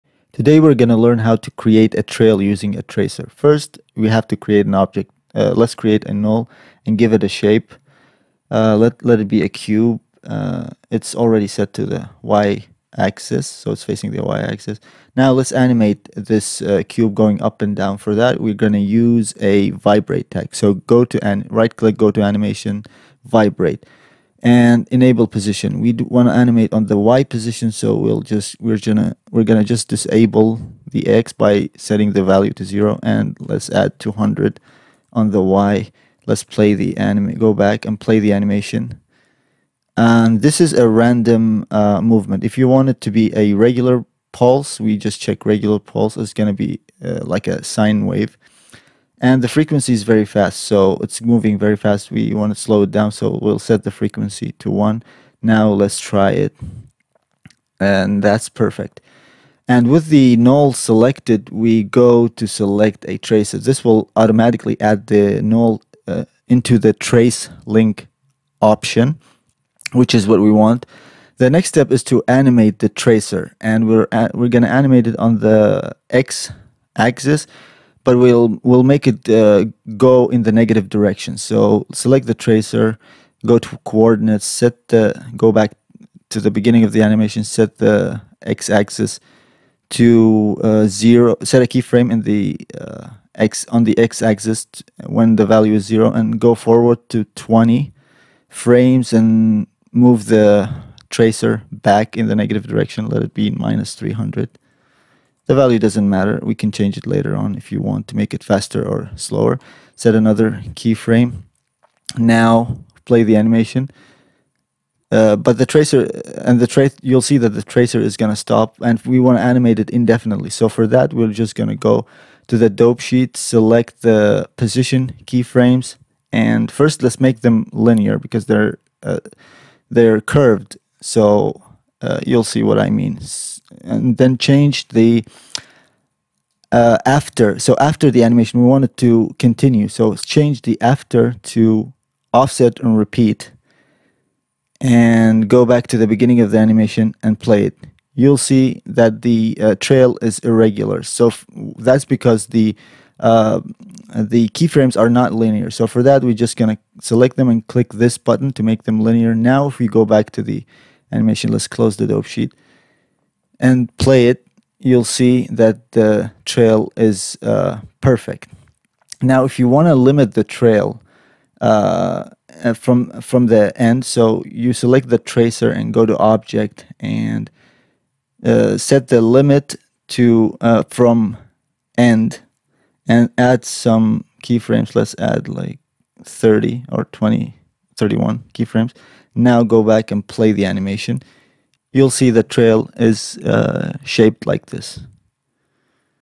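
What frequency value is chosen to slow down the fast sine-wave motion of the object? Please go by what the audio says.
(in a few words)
1.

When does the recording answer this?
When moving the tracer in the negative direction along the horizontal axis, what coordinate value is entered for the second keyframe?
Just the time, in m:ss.
1:43.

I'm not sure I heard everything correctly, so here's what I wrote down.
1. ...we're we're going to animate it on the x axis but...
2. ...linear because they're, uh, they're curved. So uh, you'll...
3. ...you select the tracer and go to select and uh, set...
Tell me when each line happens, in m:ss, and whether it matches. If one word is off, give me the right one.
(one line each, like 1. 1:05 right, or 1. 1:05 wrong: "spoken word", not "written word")
1. 1:13 right
2. 2:07 right
3. 2:54 wrong: "object", not "select".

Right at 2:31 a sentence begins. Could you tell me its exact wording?
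So that's because the uh, the keyframes are not linear.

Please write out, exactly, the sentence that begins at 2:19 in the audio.
So change the after to offset and repeat and go back to the beginning of the animation and play it.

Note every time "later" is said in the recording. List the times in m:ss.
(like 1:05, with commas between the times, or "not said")
1:47.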